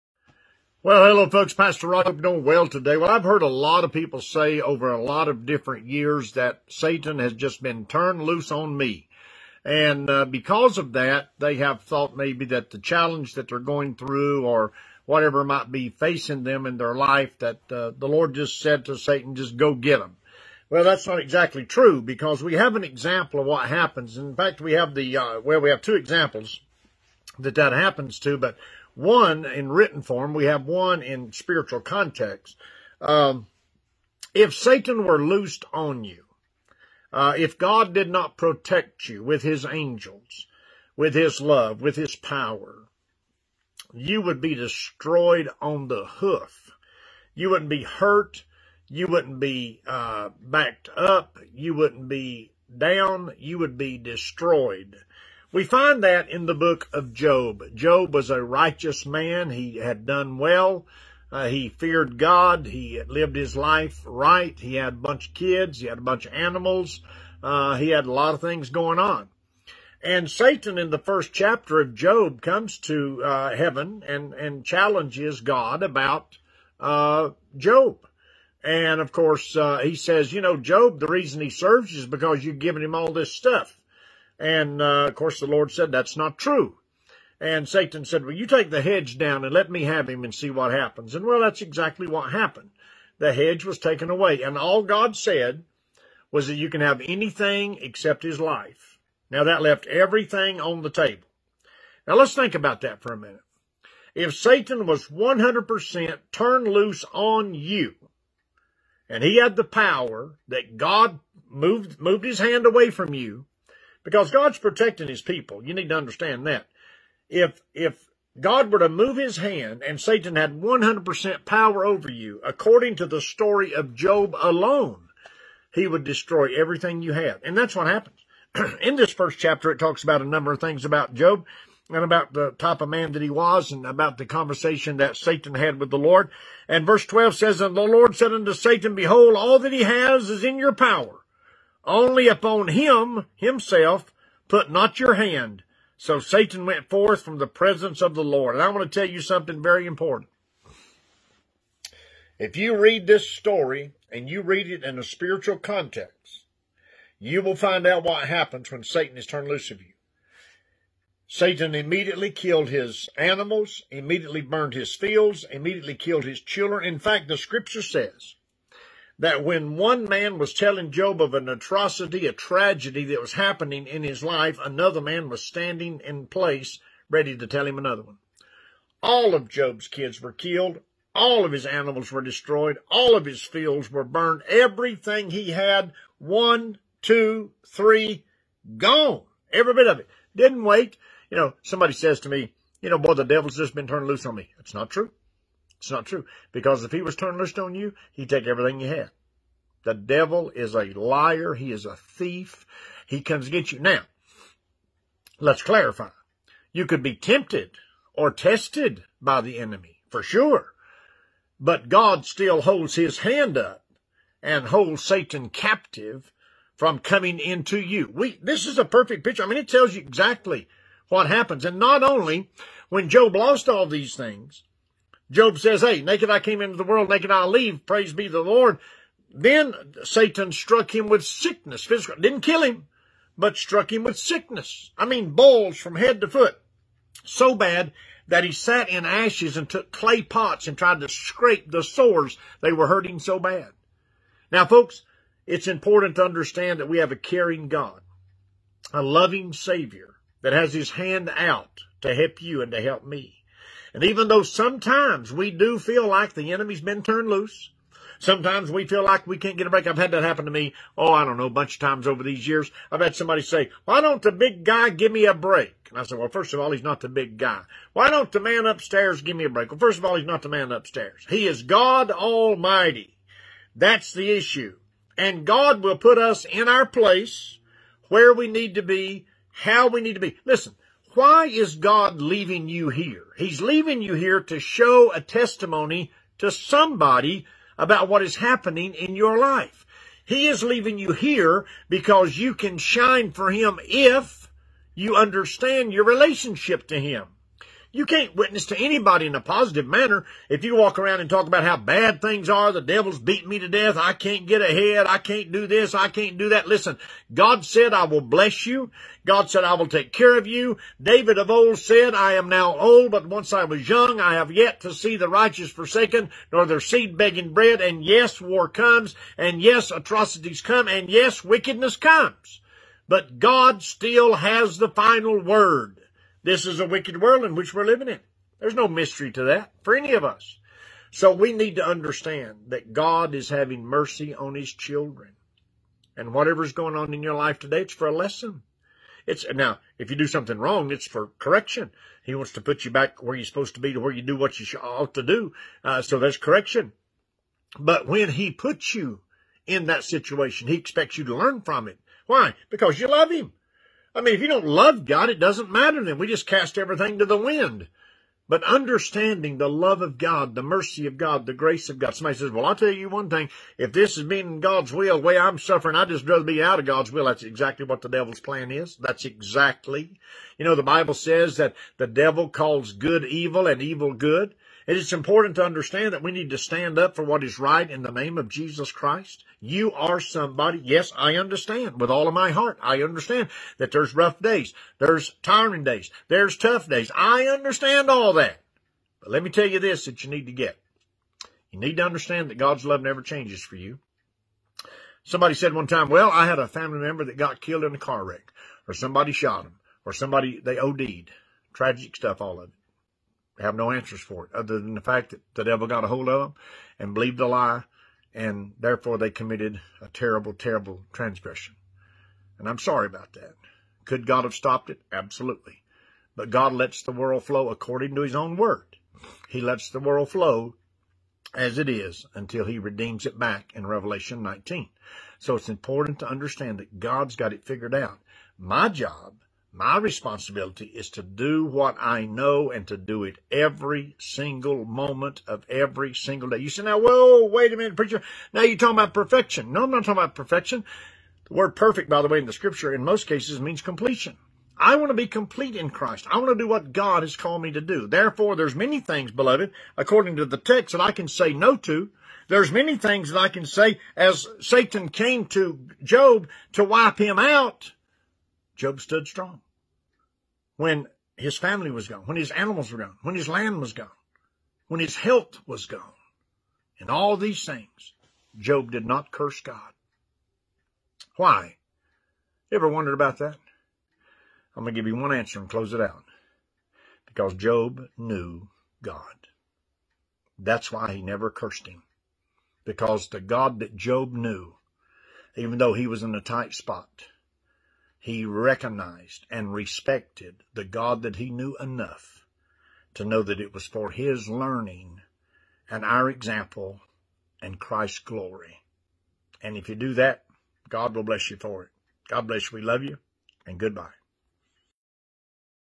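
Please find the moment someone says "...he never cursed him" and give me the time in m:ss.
8:01.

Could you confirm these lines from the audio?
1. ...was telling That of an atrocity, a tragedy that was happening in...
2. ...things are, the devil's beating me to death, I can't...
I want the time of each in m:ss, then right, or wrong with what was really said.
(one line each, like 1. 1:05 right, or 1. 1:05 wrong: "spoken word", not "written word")
1. 2:50 wrong: "Job", not "That"
2. 5:02 right.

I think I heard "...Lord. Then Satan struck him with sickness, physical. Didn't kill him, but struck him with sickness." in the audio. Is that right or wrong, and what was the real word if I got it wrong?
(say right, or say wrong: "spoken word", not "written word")
right.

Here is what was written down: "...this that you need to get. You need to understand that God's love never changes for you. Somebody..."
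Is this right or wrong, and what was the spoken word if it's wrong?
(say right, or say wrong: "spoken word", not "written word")
right.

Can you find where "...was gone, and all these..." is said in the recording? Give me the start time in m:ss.
7:45.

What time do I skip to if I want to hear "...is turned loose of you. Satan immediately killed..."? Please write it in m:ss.
2:39.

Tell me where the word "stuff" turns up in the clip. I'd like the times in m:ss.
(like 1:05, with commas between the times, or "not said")
1:23, 6:42.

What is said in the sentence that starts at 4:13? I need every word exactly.
And even though sometimes we do feel like the enemy's been turned loose, sometimes we feel like we can't get a break.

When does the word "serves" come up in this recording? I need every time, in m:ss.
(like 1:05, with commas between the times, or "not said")
1:21.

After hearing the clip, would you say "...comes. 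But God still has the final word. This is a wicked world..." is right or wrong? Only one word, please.
right.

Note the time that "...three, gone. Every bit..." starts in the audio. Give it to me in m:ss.
3:07.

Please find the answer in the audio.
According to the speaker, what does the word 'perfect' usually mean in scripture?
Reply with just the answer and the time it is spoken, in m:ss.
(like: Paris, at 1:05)
Completion, at 7:23.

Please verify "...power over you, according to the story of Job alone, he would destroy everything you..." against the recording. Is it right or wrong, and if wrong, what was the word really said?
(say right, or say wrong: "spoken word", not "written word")
right.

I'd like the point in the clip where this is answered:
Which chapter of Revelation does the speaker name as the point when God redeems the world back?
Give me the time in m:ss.
7:03.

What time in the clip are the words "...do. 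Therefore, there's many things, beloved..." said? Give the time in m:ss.
7:27.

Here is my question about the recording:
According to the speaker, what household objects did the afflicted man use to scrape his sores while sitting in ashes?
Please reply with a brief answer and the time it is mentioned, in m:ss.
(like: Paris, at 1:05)
Clay pots, at 3:59.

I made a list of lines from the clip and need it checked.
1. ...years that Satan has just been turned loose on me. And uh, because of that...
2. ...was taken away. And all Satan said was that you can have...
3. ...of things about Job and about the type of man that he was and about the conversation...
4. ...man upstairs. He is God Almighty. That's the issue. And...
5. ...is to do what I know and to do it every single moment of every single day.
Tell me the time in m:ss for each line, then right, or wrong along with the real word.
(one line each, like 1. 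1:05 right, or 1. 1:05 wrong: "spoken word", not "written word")
1. 0:05 right
2. 1:33 wrong: "God", not "Satan"
3. 2:10 right
4. 4:30 right
5. 7:10 right.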